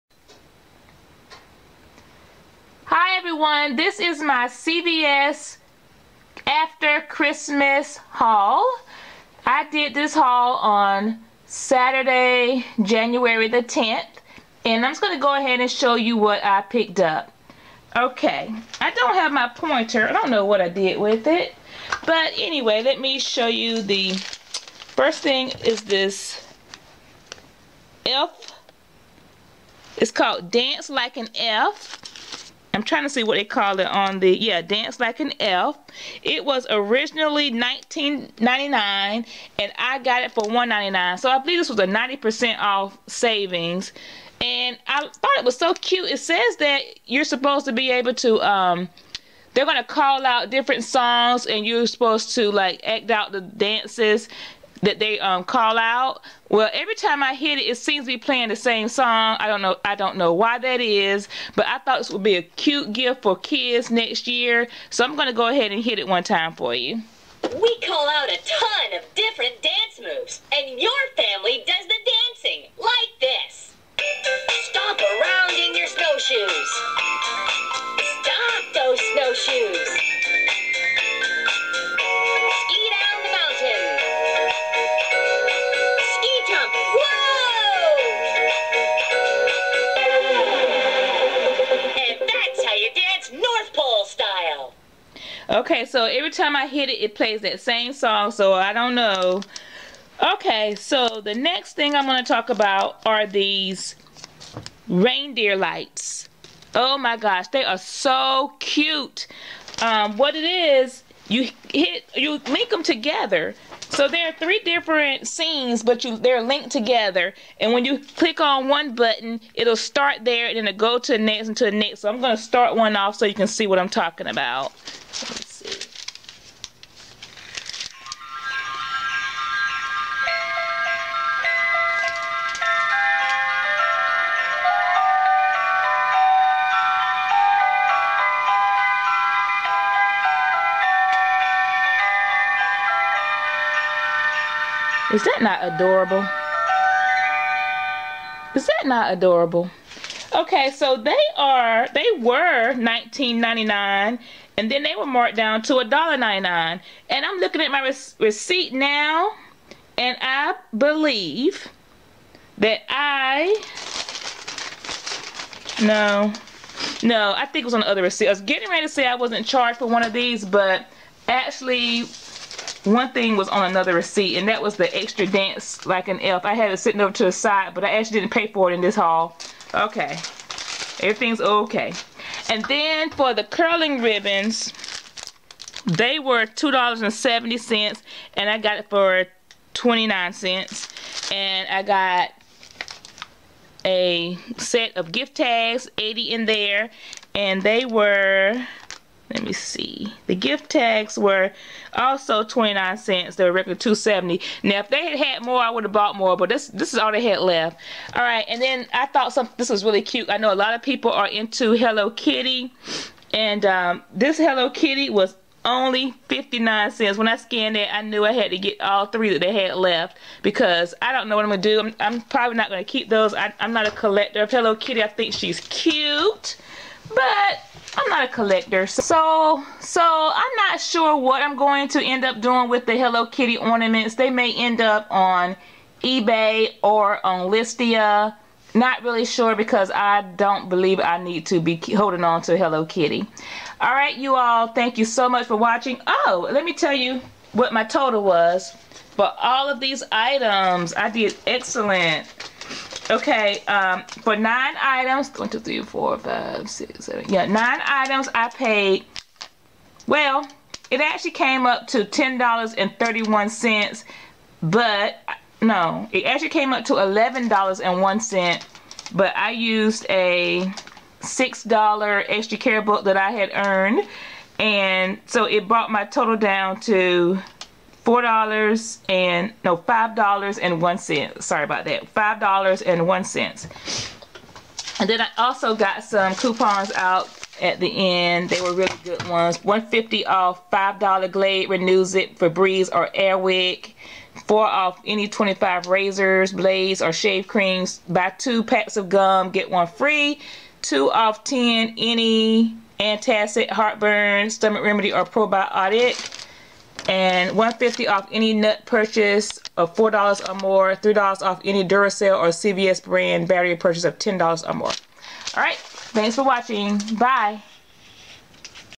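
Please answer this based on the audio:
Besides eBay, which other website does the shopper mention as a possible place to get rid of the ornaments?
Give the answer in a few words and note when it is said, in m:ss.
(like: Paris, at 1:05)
Listia, at 3:57.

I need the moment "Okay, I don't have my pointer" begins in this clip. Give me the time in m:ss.
0:17.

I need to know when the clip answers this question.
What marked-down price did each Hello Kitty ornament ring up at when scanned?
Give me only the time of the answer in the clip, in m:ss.
3:36.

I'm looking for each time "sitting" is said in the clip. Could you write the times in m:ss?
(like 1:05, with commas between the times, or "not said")
2:56.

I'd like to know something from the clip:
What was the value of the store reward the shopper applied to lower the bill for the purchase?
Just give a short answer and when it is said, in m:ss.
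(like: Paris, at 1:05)
$6, at 4:31.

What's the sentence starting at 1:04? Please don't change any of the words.
So I'm gonna go ahead and hit it one time for you.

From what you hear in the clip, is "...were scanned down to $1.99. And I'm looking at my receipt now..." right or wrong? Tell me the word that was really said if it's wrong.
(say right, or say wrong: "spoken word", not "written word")
wrong: "marked", not "scanned".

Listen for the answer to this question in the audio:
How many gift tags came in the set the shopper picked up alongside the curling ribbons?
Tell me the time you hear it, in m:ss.
3:15.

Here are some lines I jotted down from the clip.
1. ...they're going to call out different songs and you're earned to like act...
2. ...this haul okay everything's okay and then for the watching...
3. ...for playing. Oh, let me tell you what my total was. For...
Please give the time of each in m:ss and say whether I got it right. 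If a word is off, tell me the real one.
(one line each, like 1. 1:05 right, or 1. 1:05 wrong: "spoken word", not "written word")
1. 0:49 wrong: "supposed", not "earned"
2. 2:58 wrong: "curling", not "watching"
3. 4:05 wrong: "watching", not "playing".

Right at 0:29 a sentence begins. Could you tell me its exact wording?
It's called Dance Like an Elf.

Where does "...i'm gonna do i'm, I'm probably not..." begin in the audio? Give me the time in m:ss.
3:41.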